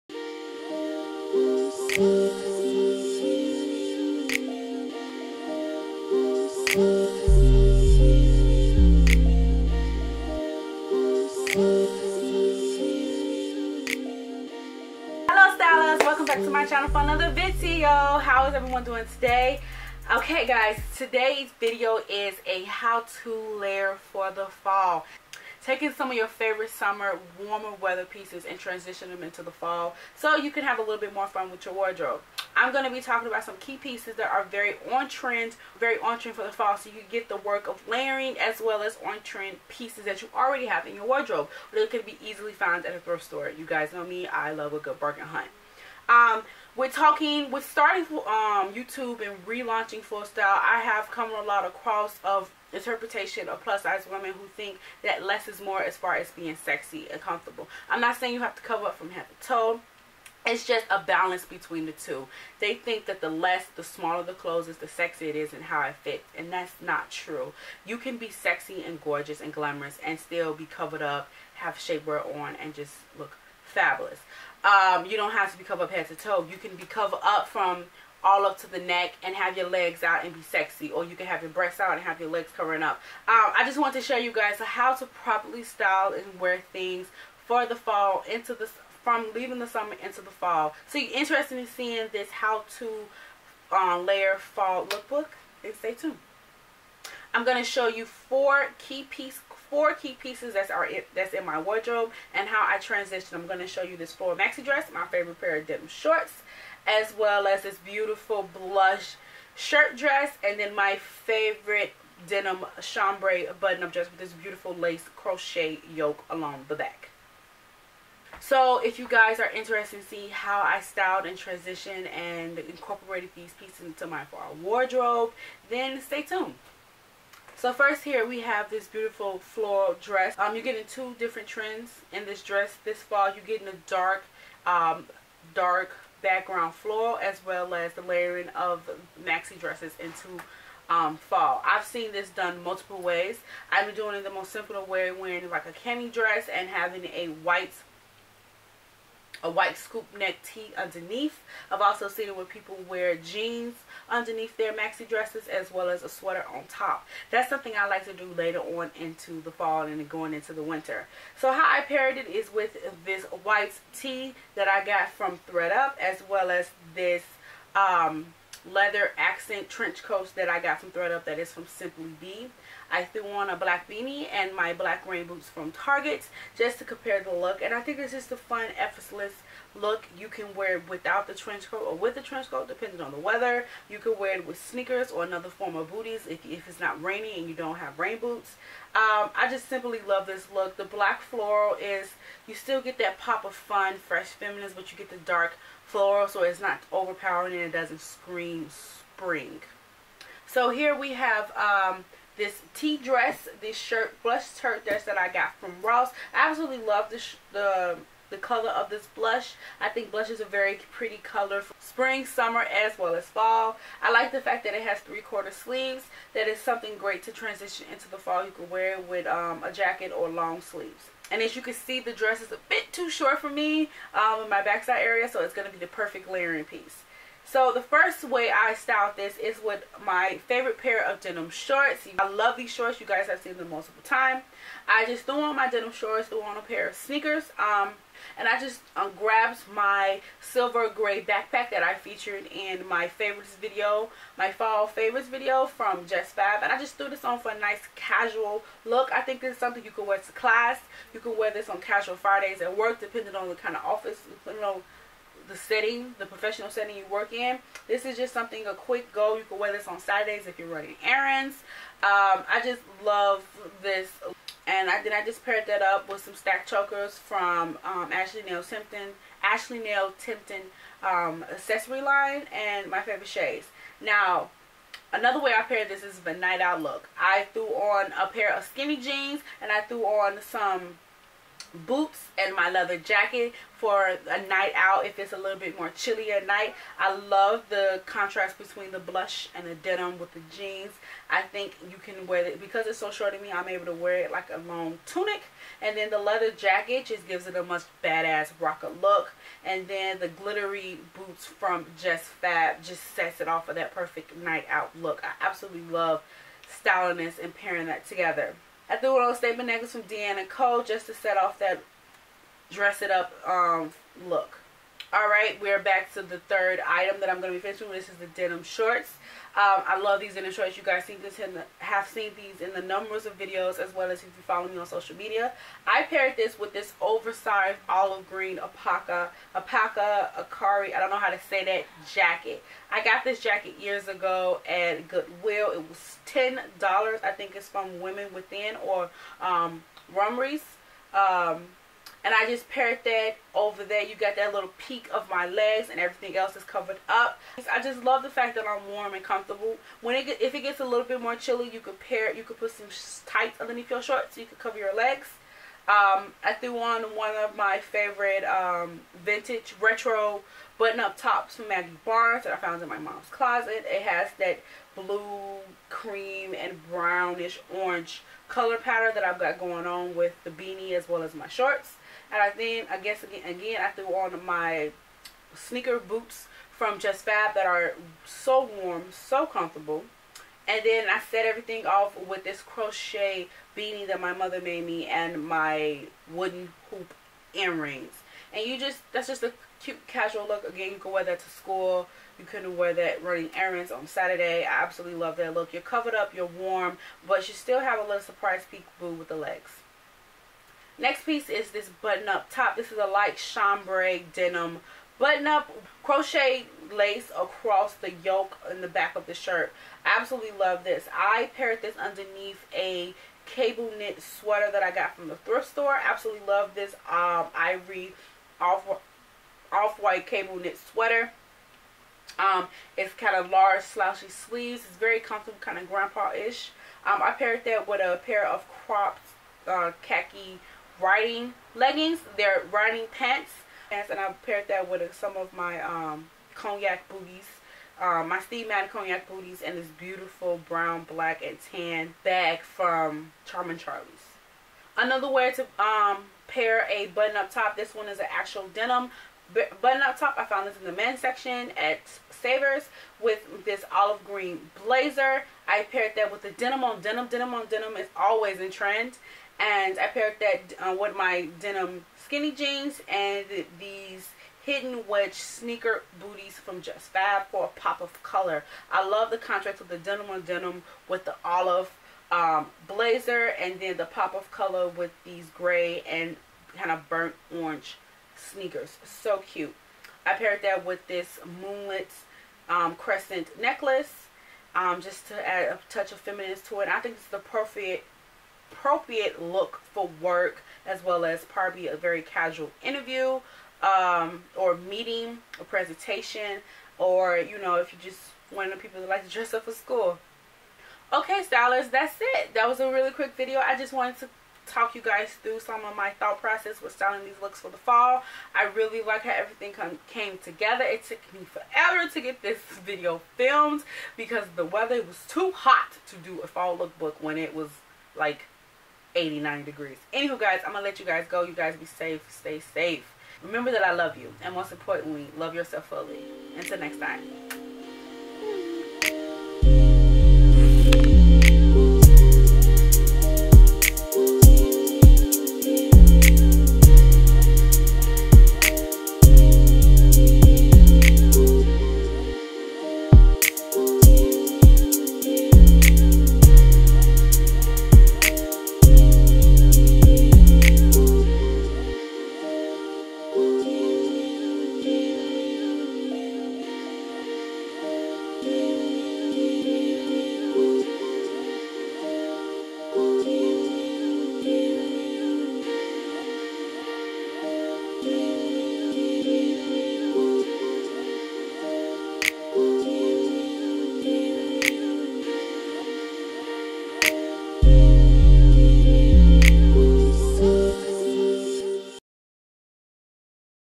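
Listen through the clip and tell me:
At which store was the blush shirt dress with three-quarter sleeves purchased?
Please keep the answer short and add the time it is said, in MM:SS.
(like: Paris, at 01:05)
Ross, at 03:25.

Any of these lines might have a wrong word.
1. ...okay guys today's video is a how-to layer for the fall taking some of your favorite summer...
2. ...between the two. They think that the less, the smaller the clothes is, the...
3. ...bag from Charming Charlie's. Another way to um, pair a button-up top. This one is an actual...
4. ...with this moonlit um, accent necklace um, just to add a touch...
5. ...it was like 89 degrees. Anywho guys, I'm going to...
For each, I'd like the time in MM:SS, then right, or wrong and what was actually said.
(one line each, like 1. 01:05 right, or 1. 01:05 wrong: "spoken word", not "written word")
1. 00:20 right
2. 01:01 right
3. 07:22 right
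4. 08:00 wrong: "crescent", not "accent"
5. 08:37 right.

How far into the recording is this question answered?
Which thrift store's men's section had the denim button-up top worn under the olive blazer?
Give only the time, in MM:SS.
07:32.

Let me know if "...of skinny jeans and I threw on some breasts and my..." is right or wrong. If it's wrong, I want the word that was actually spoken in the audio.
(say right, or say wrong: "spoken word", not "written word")
wrong: "boots", not "breasts".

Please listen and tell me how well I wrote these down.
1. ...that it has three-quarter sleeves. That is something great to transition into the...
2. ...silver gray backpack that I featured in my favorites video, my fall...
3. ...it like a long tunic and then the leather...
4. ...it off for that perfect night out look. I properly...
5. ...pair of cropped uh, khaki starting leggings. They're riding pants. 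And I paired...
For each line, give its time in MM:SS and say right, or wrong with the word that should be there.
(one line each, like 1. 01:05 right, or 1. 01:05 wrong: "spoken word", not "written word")
1. 03:34 right
2. 04:00 right
3. 04:54 right
4. 05:03 wrong: "absolutely", not "properly"
5. 07:08 wrong: "riding", not "starting".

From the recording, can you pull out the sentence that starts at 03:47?
So the first way I styled this is with my favorite pair of denim shorts.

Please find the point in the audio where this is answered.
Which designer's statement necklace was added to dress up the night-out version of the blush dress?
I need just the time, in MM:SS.
05:10.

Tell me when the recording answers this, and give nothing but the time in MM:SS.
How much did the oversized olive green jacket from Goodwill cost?
05:36.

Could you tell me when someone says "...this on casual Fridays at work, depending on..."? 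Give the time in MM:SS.
04:11.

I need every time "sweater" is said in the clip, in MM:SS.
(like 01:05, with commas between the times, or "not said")
02:36, 06:54, 07:00.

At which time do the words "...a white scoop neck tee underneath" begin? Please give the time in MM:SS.
02:29.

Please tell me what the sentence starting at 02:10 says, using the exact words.
Um, you're getting two different trends in this dress this fall.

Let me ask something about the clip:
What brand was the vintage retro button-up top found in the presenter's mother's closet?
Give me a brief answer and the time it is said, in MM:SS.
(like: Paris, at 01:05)
Maggie Barnes, at 06:01.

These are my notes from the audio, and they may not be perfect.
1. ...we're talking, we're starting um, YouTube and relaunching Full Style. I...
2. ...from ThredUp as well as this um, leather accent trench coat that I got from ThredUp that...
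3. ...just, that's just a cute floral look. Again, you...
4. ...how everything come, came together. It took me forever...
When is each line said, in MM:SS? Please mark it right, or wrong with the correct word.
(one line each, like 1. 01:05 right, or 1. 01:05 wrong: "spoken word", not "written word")
1. 00:46 right
2. 02:45 right
3. 06:28 wrong: "casual", not "floral"
4. 08:29 right.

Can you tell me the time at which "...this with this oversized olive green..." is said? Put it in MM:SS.
05:26.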